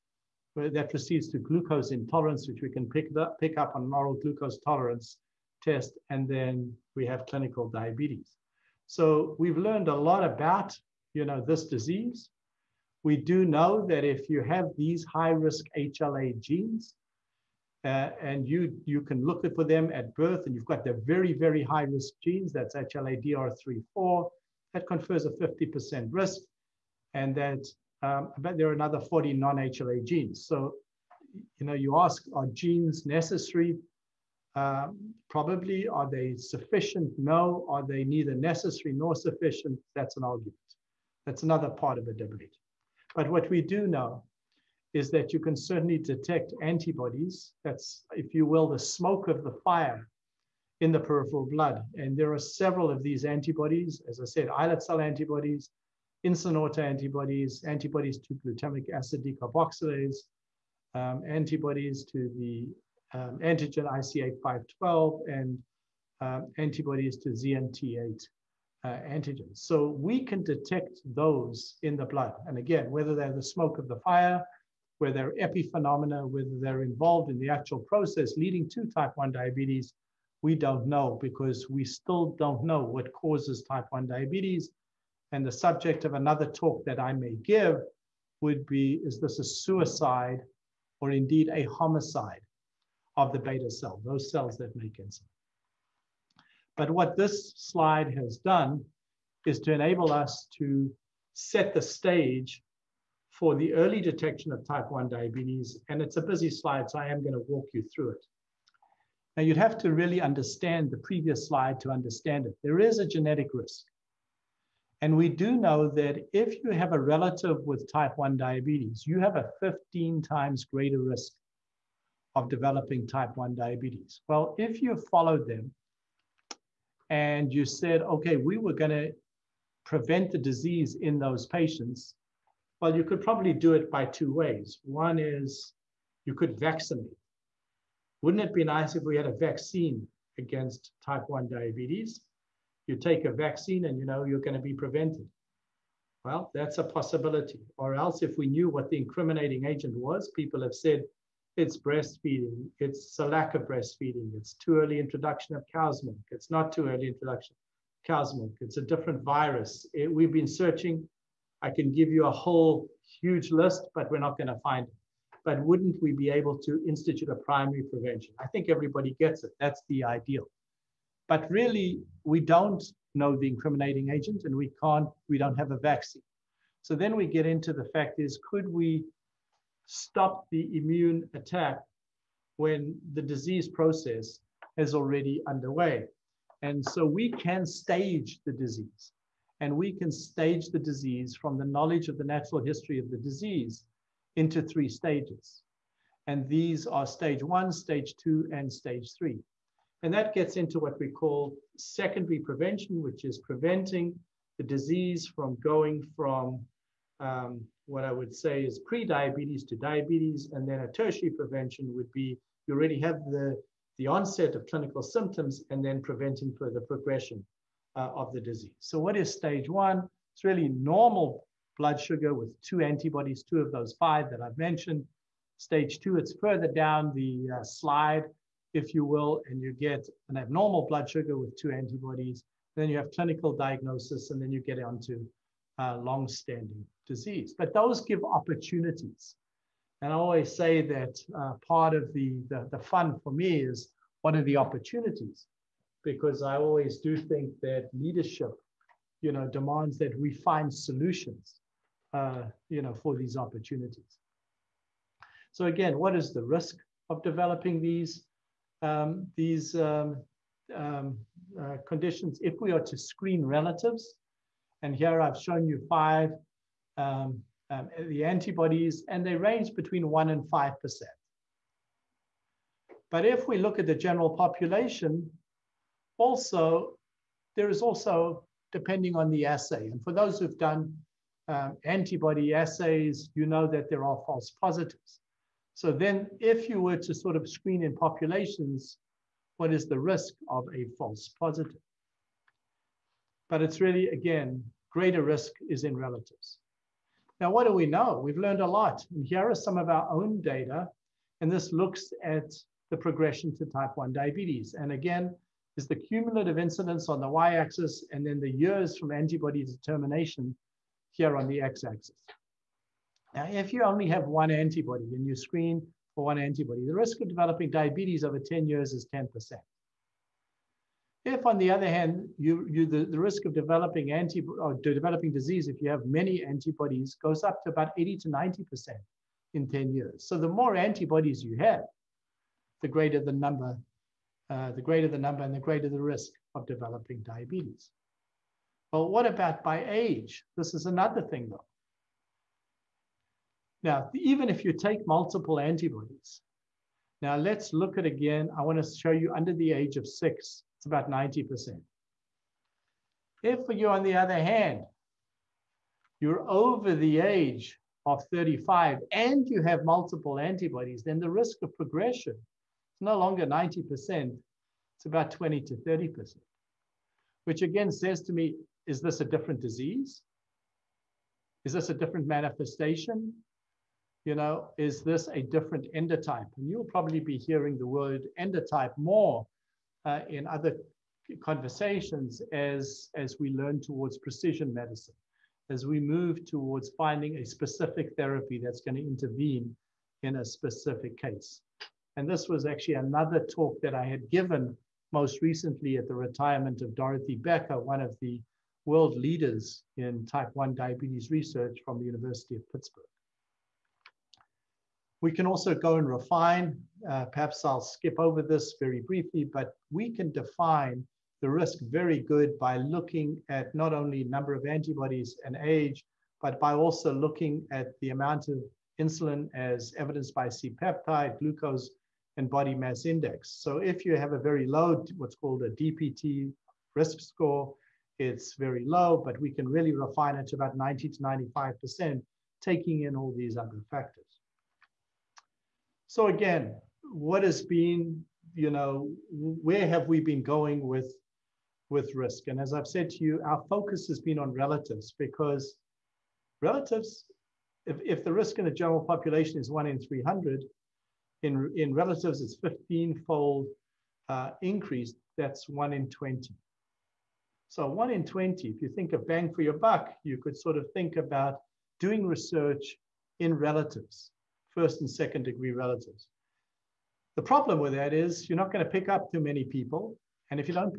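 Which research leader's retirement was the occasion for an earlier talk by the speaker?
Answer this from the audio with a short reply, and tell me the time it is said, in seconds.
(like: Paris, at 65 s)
Dorothy Becker, at 396 s.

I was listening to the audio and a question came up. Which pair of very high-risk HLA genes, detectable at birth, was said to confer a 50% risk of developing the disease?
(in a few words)
HLA-DR3-4.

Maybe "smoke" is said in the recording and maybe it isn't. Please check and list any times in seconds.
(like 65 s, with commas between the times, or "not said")
48 s, 73 s.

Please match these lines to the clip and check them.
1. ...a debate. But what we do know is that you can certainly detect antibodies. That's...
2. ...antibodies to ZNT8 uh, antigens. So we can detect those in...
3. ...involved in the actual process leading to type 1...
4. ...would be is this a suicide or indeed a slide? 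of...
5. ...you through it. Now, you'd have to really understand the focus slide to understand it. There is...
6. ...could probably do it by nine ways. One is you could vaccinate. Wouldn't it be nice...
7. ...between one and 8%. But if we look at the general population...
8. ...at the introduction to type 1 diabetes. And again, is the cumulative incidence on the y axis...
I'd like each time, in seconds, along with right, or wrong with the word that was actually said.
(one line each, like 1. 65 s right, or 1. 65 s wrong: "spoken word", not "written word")
1. 42 s right
2. 66 s right
3. 76 s right
4. 88 s wrong: "homicide", not "slide"
5. 107 s wrong: "previous", not "focus"
6. 133 s wrong: "two", not "nine"
7. 269 s wrong: "5", not "8"
8. 302 s wrong: "progression", not "introduction".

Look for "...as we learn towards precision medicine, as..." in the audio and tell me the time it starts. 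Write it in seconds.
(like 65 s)
383 s.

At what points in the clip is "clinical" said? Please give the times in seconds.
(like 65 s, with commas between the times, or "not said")
7 s, 214 s, 233 s.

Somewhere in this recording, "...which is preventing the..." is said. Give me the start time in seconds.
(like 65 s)
203 s.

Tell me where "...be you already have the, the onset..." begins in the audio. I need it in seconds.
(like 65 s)
212 s.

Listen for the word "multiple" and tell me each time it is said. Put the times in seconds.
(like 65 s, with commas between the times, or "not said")
345 s, 359 s.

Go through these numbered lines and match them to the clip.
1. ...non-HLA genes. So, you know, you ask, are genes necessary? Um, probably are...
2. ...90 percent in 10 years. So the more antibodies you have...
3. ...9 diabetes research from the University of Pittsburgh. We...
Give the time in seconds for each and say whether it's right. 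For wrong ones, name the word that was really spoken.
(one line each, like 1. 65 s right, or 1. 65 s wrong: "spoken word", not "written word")
1. 29 s right
2. 328 s right
3. 400 s wrong: "1", not "9".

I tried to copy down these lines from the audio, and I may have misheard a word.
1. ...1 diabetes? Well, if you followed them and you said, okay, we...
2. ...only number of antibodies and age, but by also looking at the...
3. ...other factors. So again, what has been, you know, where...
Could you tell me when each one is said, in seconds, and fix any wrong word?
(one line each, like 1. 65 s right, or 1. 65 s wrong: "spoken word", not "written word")
1. 123 s right
2. 413 s right
3. 433 s right.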